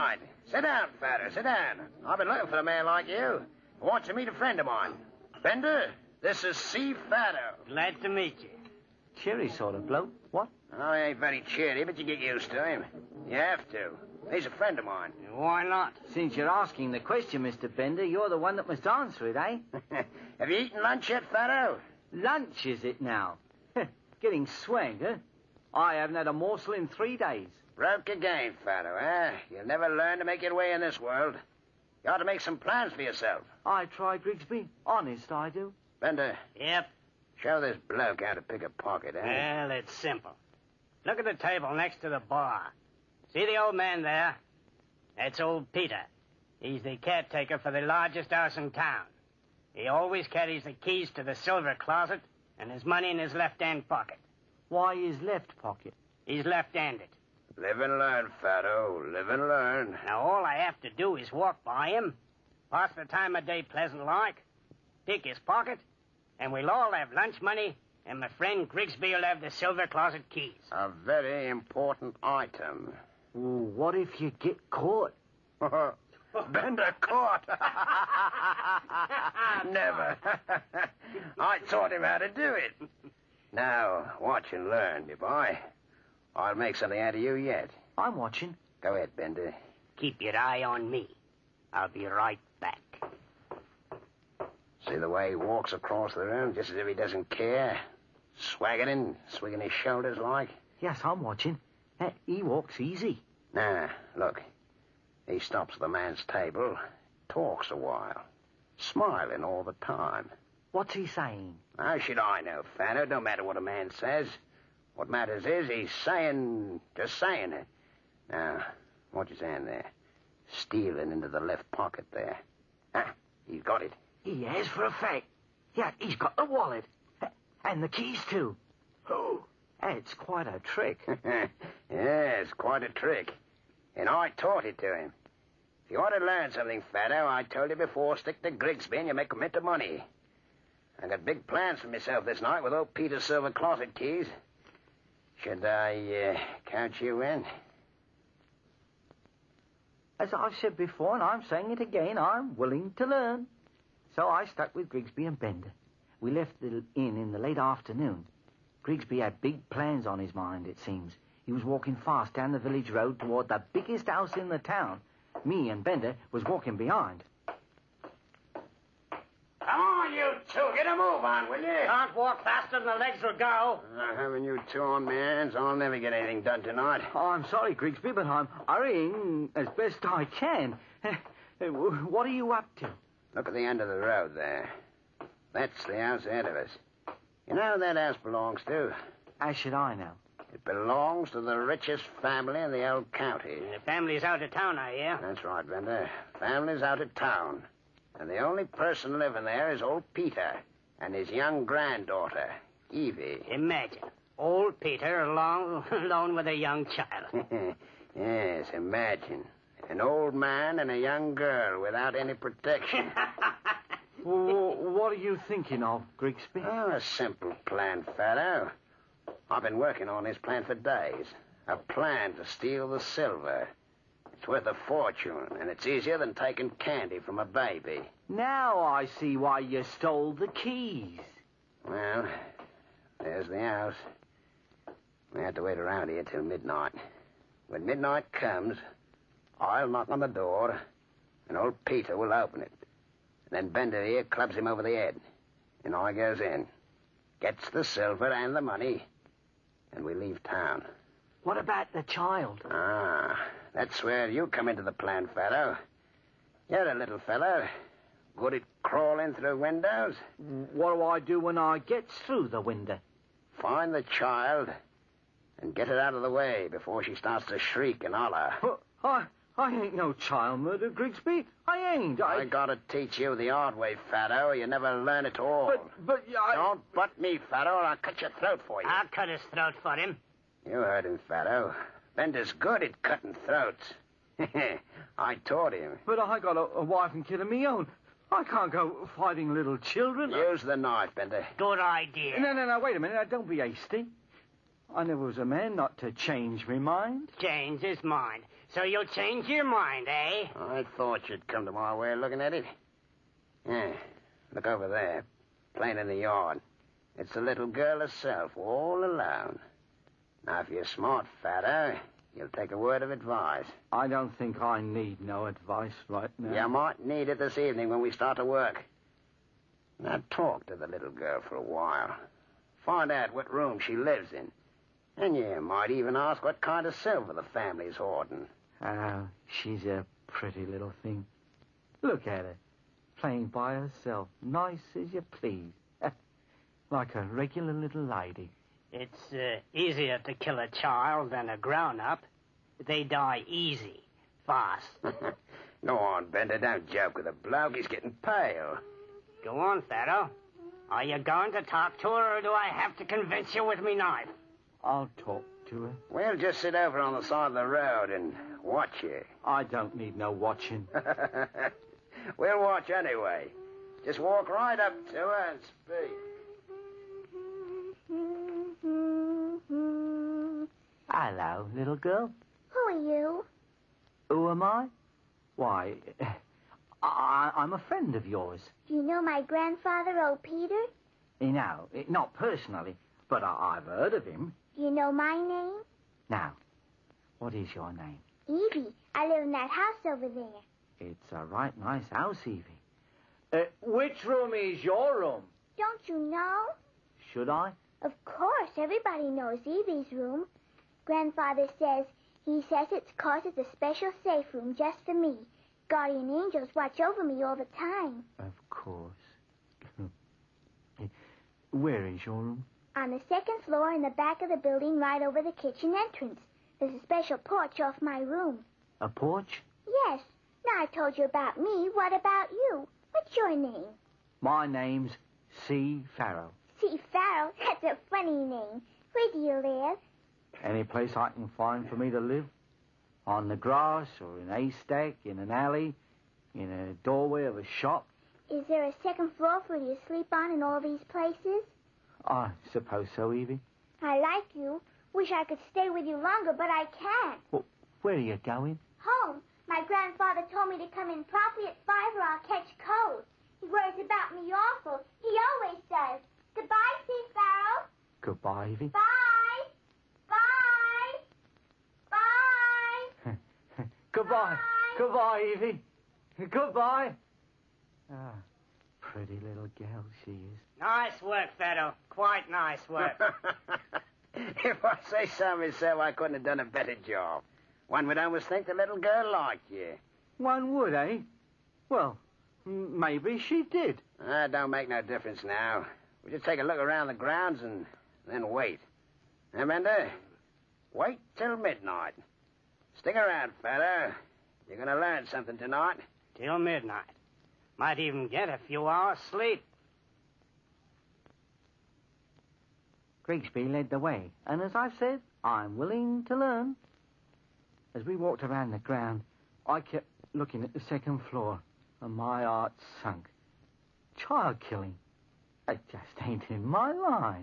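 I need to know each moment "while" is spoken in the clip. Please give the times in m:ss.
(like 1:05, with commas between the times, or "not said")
1:47, 5:21.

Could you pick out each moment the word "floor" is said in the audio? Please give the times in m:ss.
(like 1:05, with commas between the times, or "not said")
6:53, 7:19, 8:31.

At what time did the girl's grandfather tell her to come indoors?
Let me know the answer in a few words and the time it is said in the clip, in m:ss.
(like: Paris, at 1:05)
5, at 7:31.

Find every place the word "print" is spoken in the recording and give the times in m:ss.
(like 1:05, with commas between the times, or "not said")
not said.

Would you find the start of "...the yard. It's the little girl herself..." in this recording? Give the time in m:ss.
5:06.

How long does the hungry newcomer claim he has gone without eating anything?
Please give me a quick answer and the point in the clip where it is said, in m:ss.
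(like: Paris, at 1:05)
3 days, at 0:26.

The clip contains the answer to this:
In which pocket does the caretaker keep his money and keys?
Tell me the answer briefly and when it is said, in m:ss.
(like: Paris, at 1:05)
left-hand pocket, at 0:53.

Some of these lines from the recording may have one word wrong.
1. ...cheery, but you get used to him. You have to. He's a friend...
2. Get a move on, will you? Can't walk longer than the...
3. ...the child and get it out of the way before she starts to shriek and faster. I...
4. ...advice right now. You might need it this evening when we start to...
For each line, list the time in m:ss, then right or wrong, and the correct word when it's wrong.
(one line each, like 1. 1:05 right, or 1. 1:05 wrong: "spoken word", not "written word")
1. 0:11 right
2. 2:50 wrong: "faster", not "longer"
3. 4:23 wrong: "holler", not "faster"
4. 5:15 right.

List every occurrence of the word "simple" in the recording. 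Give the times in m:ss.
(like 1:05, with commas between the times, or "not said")
0:39, 3:36.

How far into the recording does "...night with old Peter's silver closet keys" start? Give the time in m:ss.
2:22.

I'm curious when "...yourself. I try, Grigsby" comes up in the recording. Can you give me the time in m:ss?
0:33.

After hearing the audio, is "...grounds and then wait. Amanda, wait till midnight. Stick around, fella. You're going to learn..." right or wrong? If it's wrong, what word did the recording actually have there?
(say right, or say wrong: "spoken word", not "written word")
right.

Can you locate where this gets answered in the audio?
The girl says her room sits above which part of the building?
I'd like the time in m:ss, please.
6:55.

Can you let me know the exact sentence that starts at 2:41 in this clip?
He was walking fast down the village road toward the biggest house in the town.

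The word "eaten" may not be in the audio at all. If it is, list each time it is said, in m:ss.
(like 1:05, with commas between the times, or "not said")
0:20.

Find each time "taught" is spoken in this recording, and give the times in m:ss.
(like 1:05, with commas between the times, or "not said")
1:21, 2:14, 4:45.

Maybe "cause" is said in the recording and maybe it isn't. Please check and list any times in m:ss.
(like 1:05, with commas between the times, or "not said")
6:43.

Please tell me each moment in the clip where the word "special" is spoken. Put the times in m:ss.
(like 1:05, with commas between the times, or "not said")
6:43, 6:57.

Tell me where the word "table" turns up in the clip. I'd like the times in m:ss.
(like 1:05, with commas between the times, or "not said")
0:41, 1:46.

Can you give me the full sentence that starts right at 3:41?
A plan to steal the silver.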